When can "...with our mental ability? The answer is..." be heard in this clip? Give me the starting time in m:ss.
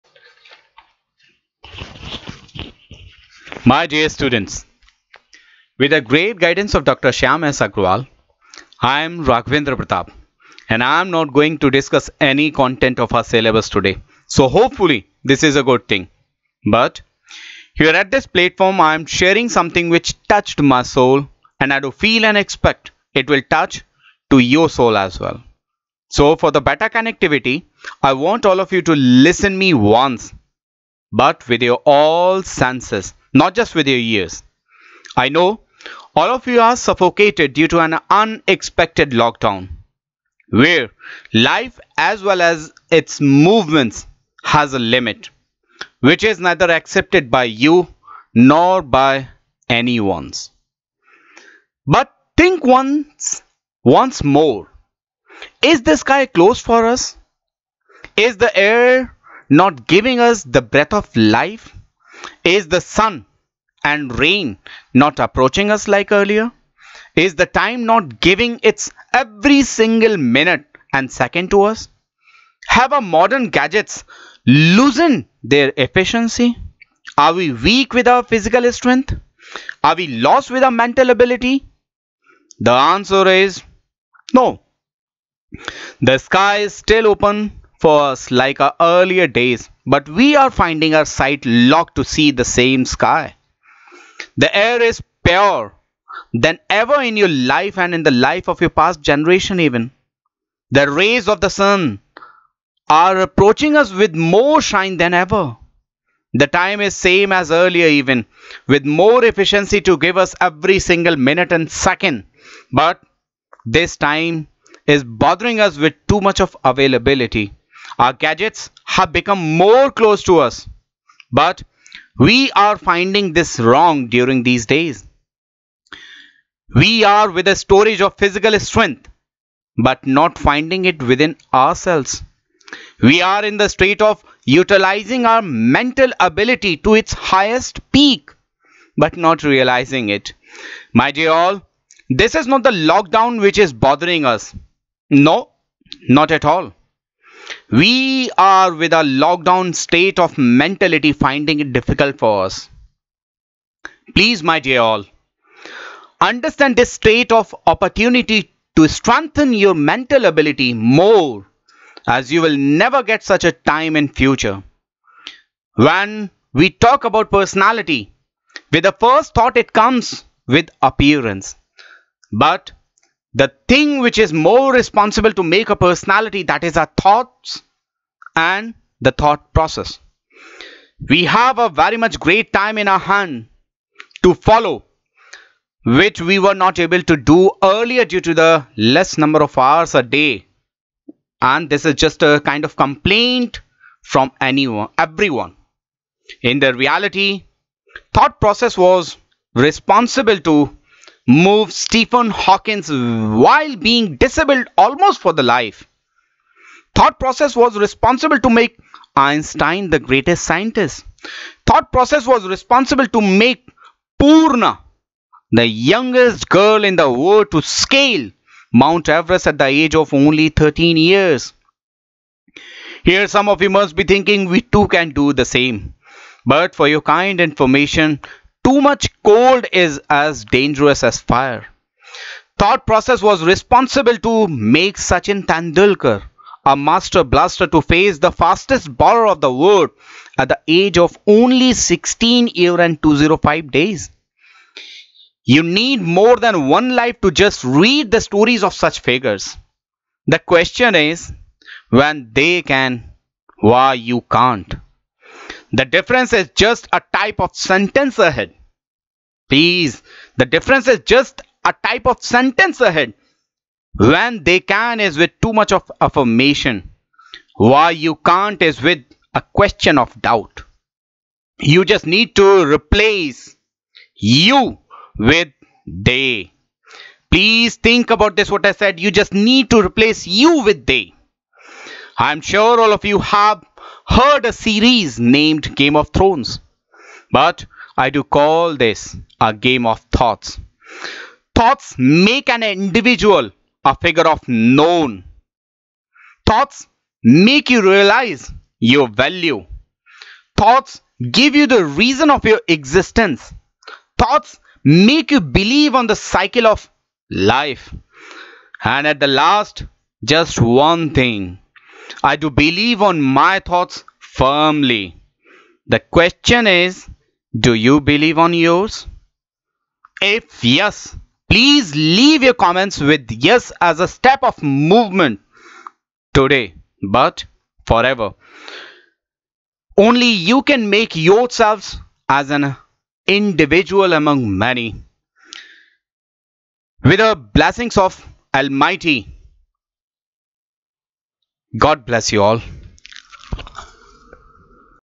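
1:20.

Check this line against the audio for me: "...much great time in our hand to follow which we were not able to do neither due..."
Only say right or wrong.
wrong.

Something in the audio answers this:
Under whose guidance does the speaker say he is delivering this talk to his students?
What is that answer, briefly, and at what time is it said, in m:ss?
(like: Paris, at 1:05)
Dr. Shyam S. Agrawal, at 0:06.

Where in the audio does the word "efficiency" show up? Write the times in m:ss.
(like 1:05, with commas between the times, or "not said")
1:15, 1:49.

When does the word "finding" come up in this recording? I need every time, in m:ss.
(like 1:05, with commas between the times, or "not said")
1:30, 2:02, 2:10, 2:31.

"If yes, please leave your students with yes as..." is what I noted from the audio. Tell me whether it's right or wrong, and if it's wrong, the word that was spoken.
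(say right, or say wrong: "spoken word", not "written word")
wrong: "comments", not "students".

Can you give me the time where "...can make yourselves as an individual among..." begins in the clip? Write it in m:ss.
5:30.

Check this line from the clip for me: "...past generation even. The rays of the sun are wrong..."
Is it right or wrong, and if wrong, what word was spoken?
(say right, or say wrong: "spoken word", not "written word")
wrong: "approaching", not "wrong".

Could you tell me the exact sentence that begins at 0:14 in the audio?
So hopefully this is a good thing.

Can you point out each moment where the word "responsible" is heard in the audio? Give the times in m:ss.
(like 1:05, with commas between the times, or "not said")
2:54, 3:19, 3:27, 3:32, 3:53.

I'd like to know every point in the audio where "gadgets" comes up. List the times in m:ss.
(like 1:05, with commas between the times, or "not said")
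1:13, 1:58.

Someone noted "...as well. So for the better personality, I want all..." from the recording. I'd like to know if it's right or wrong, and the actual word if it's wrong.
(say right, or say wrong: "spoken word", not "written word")
wrong: "connectivity", not "personality".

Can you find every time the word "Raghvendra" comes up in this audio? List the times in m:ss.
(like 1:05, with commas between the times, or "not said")
0:09.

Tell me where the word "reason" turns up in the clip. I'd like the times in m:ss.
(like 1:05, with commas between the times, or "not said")
5:01.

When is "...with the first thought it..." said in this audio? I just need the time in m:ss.
2:48.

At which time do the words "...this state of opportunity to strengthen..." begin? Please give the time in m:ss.
2:36.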